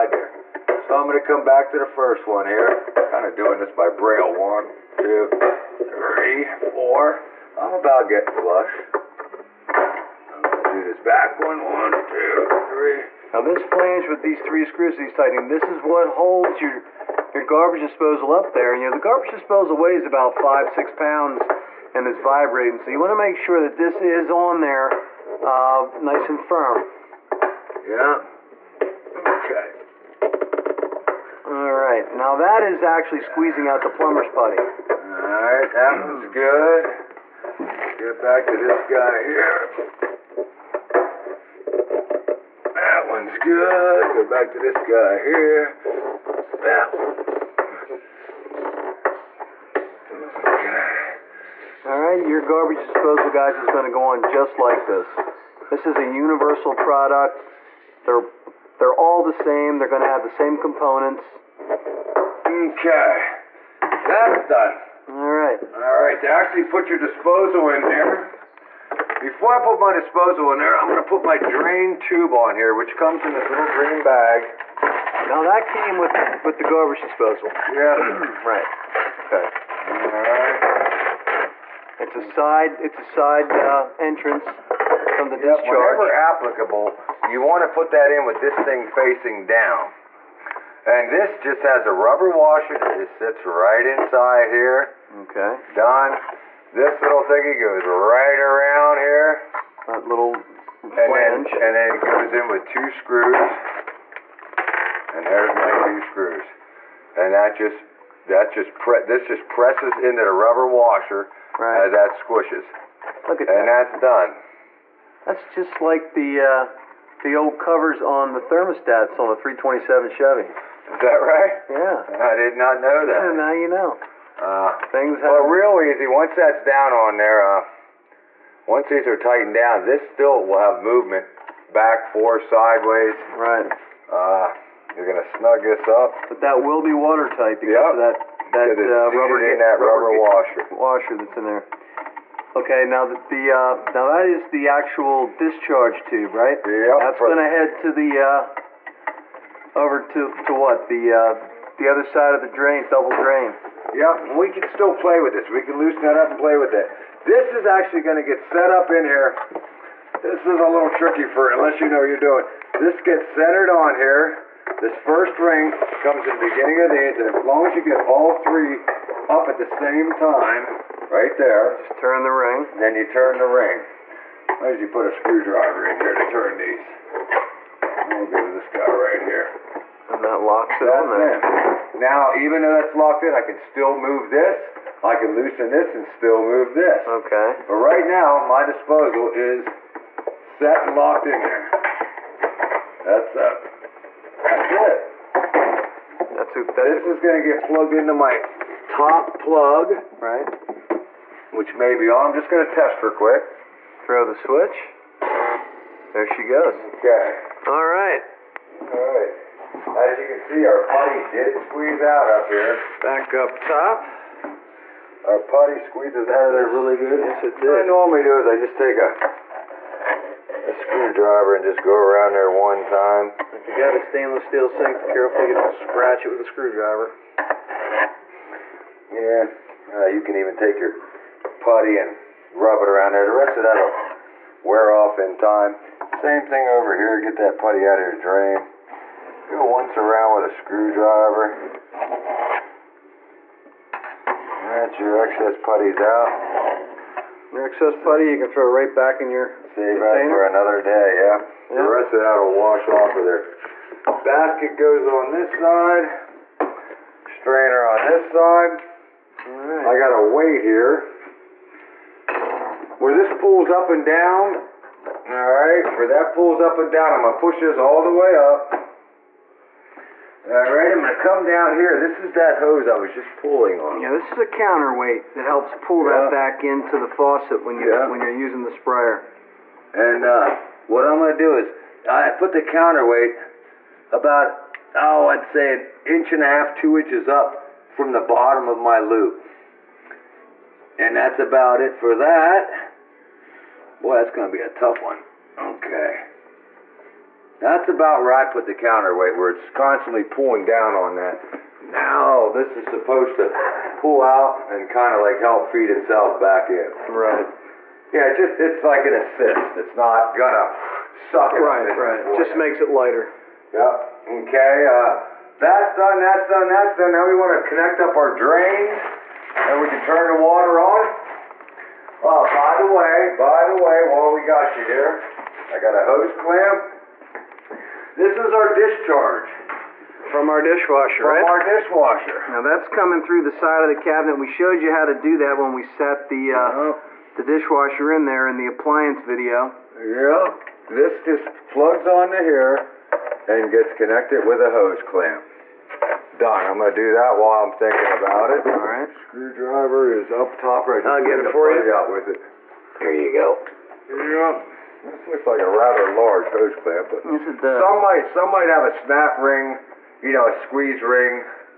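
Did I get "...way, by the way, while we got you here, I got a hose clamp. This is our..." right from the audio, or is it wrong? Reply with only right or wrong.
right.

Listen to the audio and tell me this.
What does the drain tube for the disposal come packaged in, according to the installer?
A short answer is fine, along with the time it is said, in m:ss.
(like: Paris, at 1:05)
little green bag, at 1:13.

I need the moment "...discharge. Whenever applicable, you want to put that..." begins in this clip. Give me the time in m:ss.
1:25.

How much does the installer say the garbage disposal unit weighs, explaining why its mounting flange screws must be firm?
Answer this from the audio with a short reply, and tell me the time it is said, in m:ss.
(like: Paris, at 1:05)
5 or 6 pounds, at 0:20.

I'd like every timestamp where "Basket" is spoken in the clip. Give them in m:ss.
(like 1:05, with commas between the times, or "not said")
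4:14.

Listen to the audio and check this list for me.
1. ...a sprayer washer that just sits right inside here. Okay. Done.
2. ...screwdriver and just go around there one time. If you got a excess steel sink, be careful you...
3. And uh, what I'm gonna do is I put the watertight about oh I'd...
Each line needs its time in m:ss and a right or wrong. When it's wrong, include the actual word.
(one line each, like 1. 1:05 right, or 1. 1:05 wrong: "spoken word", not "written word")
1. 1:31 wrong: "rubber", not "sprayer"
2. 3:40 wrong: "stainless", not "excess"
3. 4:39 wrong: "counterweight", not "watertight".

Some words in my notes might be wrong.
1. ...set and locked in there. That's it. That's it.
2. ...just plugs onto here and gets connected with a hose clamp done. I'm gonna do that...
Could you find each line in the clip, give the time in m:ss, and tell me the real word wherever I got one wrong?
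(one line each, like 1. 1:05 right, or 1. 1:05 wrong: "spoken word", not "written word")
1. 3:10 right
2. 5:41 right.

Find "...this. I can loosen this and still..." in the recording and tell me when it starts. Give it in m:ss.
3:04.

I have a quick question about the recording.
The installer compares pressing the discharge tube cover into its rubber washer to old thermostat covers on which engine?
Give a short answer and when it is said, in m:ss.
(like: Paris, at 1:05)
327 Chevy, at 1:59.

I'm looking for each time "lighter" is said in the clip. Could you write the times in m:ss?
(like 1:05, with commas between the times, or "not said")
5:12.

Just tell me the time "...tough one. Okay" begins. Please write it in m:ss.
4:54.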